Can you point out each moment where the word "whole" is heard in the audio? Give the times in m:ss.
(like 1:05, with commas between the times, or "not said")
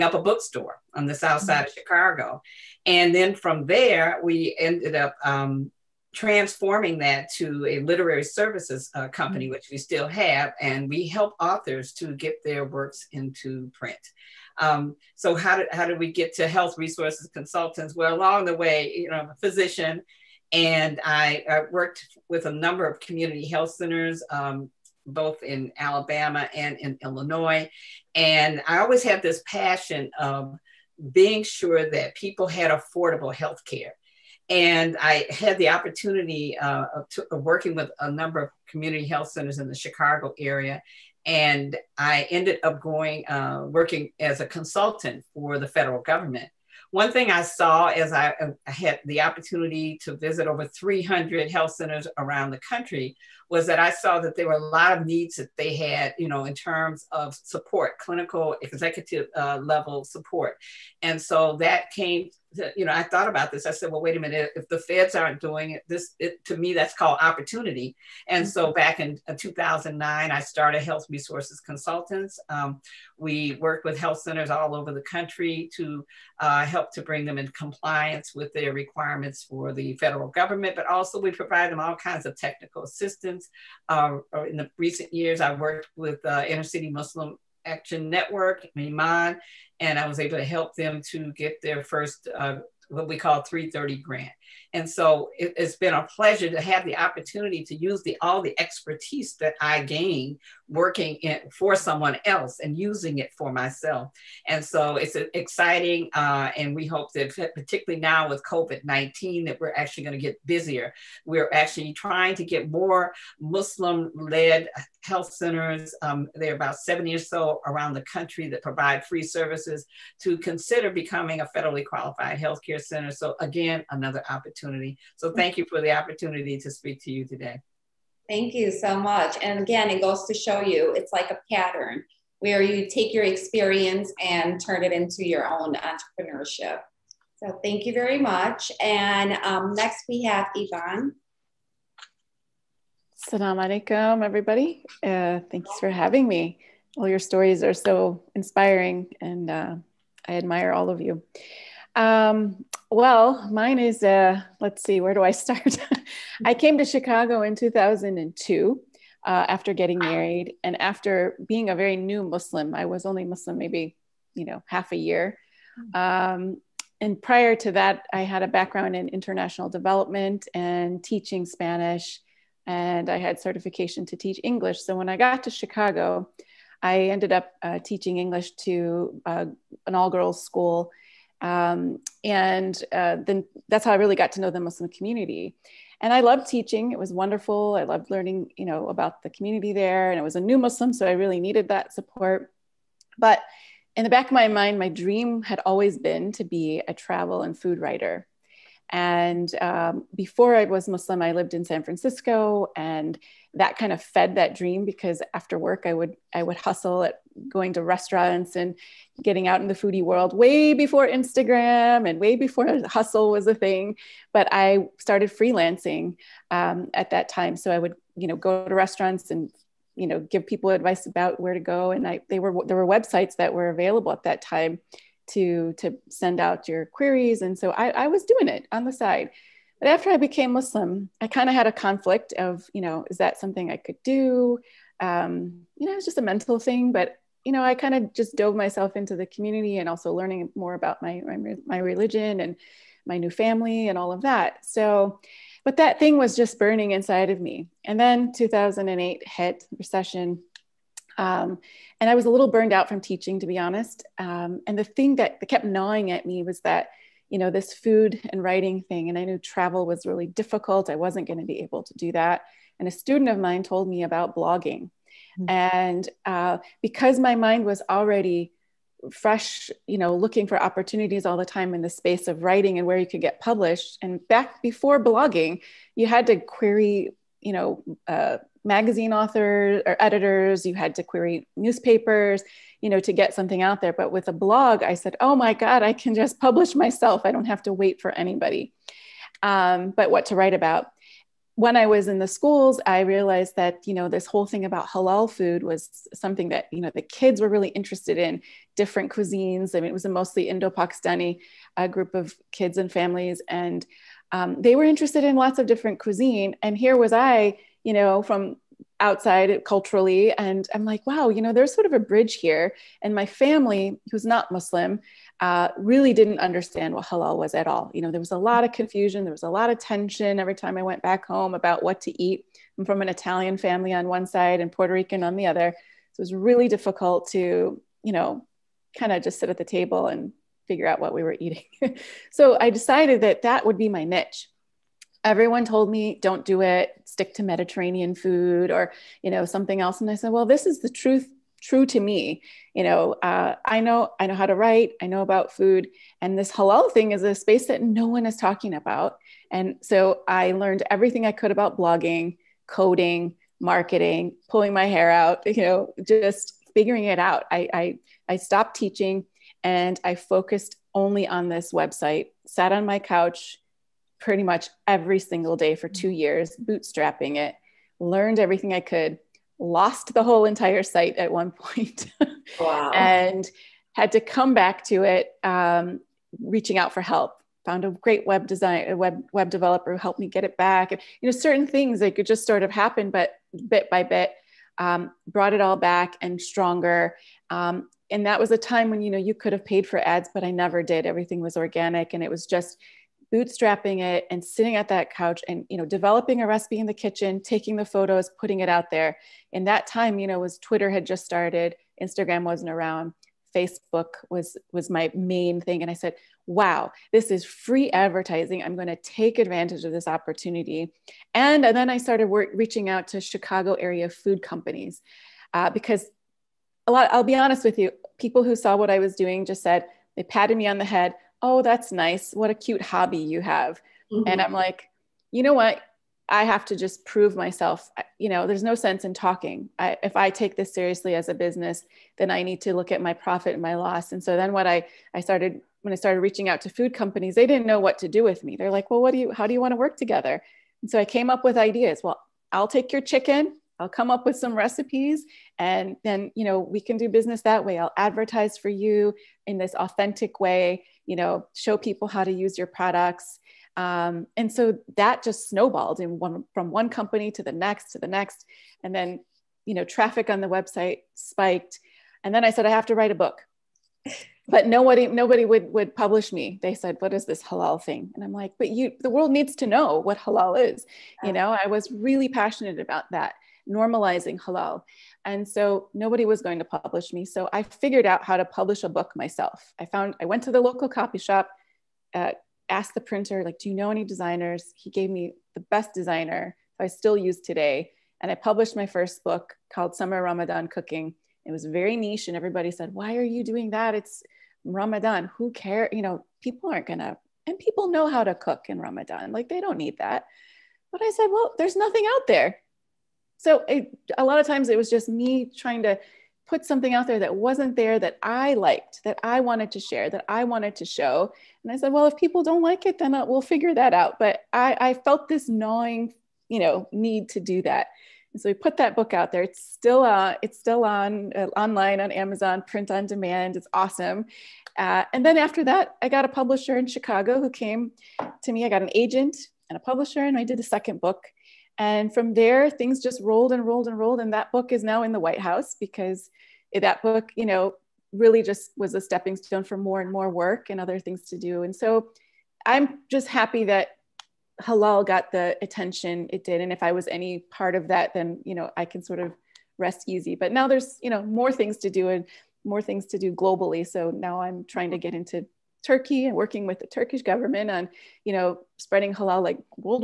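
4:54, 6:10.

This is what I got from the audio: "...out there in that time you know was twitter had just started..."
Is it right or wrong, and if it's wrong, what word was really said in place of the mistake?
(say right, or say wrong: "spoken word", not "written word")
right.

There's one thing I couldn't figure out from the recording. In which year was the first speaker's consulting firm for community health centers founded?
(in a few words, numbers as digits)
2009.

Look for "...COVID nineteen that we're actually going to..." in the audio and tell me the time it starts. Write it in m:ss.
1:48.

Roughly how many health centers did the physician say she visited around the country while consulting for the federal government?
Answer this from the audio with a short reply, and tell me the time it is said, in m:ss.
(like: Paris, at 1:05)
300, at 0:50.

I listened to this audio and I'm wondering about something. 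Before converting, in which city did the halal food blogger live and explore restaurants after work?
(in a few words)
San Francisco.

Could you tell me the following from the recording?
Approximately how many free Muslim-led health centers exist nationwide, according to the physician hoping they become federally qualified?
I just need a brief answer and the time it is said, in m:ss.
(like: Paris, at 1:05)
70, at 1:56.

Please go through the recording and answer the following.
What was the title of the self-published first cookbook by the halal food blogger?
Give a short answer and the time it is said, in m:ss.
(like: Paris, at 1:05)
Summer Ramadan Cooking, at 8:09.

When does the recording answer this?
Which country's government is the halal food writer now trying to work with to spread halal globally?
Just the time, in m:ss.
9:15.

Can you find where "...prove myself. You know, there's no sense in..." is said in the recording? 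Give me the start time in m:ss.
7:07.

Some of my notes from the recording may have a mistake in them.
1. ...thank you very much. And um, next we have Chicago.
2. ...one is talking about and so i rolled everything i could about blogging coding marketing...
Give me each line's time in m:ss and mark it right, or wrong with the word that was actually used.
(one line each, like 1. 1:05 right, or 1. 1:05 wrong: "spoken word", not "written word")
1. 2:17 wrong: "Yvonne", not "Chicago"
2. 5:48 wrong: "learned", not "rolled".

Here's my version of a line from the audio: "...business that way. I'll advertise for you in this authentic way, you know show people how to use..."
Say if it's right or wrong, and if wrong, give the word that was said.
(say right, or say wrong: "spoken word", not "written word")
right.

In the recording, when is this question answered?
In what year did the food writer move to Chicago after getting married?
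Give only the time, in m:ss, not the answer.
2:37.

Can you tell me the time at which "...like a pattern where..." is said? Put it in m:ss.
2:11.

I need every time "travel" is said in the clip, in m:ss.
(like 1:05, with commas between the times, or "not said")
3:16, 4:19.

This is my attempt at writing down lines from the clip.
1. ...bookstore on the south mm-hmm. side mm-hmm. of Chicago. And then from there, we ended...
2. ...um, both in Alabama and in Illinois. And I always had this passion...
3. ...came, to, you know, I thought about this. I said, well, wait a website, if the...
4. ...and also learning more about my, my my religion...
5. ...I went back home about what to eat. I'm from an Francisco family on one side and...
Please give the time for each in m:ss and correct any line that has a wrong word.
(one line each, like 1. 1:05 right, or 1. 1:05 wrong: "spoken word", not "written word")
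1. 0:00 right
2. 0:24 right
3. 1:01 wrong: "minute", not "website"
4. 3:59 right
5. 5:20 wrong: "Italian", not "Francisco".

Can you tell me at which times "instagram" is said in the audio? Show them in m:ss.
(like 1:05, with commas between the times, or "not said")
3:31, 6:42.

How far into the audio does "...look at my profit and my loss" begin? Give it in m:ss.
7:12.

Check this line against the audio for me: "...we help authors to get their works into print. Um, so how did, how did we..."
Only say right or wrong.
right.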